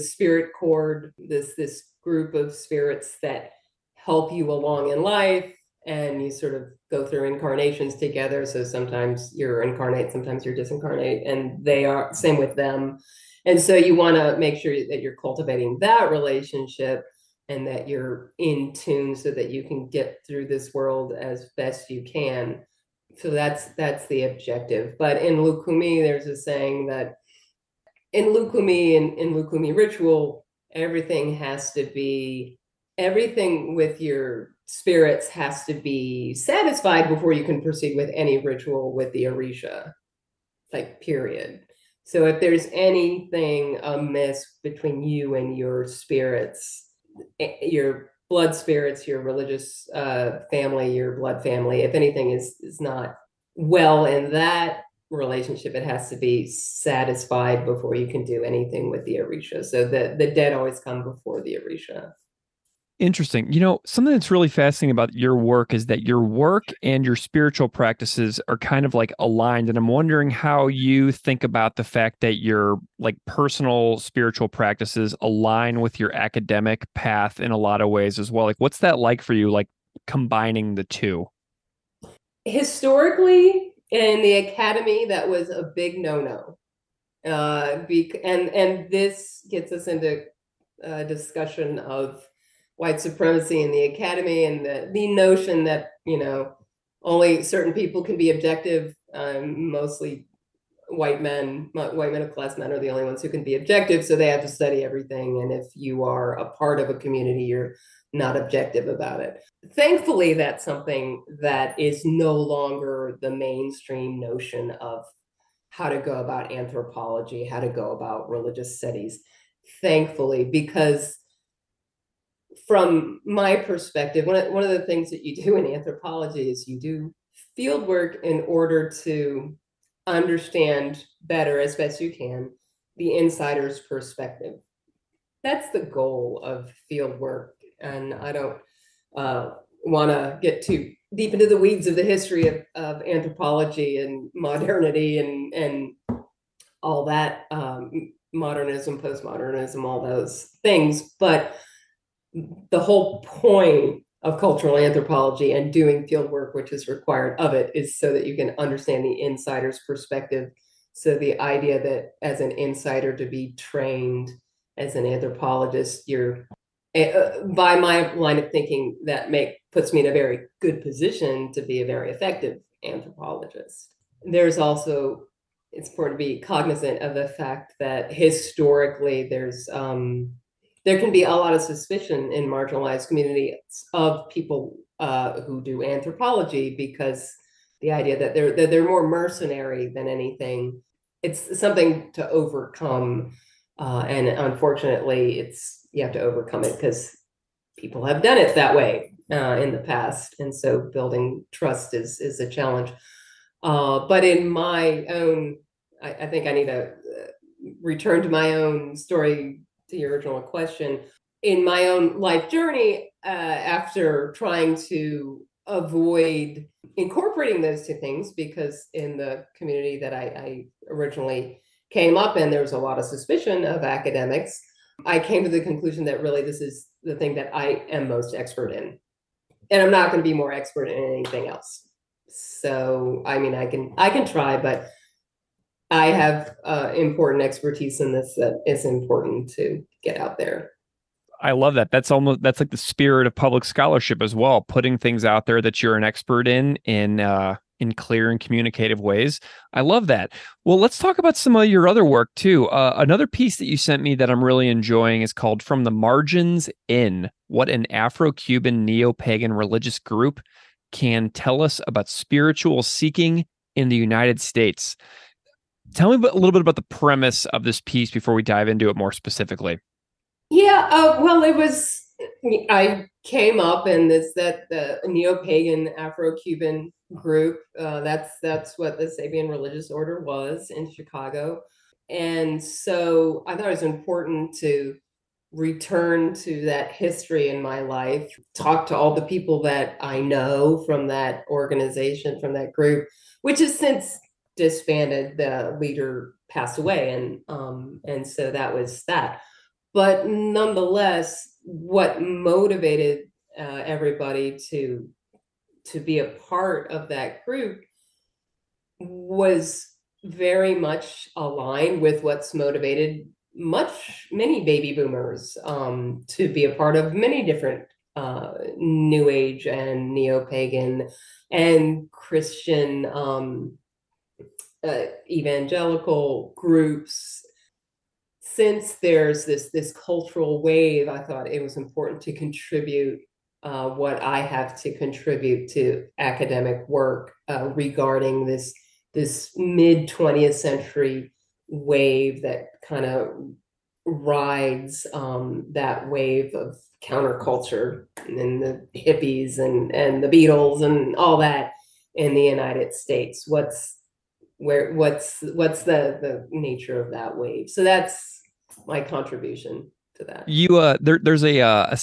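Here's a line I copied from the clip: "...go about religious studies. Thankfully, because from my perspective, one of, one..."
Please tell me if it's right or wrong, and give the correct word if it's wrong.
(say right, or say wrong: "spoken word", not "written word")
right.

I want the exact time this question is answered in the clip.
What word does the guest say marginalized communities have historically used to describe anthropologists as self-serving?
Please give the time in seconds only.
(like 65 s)
189 s.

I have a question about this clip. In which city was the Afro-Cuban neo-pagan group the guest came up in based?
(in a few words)
Chicago.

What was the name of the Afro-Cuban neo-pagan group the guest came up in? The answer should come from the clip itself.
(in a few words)
Sabian religious order.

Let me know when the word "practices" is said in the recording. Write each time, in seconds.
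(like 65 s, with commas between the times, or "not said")
67 s, 74 s.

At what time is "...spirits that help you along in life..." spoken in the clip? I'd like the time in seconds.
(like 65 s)
2 s.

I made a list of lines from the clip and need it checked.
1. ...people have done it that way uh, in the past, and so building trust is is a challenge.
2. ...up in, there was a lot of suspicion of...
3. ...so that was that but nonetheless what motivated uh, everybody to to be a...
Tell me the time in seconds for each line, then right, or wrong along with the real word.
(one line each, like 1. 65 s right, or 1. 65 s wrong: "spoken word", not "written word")
1. 197 s right
2. 222 s right
3. 298 s right.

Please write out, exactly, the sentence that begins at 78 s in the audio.
Like, what's that like for you, like combining the two?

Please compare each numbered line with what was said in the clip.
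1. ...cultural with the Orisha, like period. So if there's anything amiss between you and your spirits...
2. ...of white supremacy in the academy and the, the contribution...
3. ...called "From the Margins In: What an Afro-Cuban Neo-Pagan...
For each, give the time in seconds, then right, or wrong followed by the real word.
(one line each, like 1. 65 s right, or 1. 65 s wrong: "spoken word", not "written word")
1. 38 s wrong: "ritual", not "cultural"
2. 91 s wrong: "notion", not "contribution"
3. 255 s right.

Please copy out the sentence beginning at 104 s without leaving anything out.
So they have to study everything.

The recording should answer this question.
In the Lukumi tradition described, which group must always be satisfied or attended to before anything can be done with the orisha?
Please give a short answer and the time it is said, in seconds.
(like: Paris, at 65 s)
The dead, at 60 s.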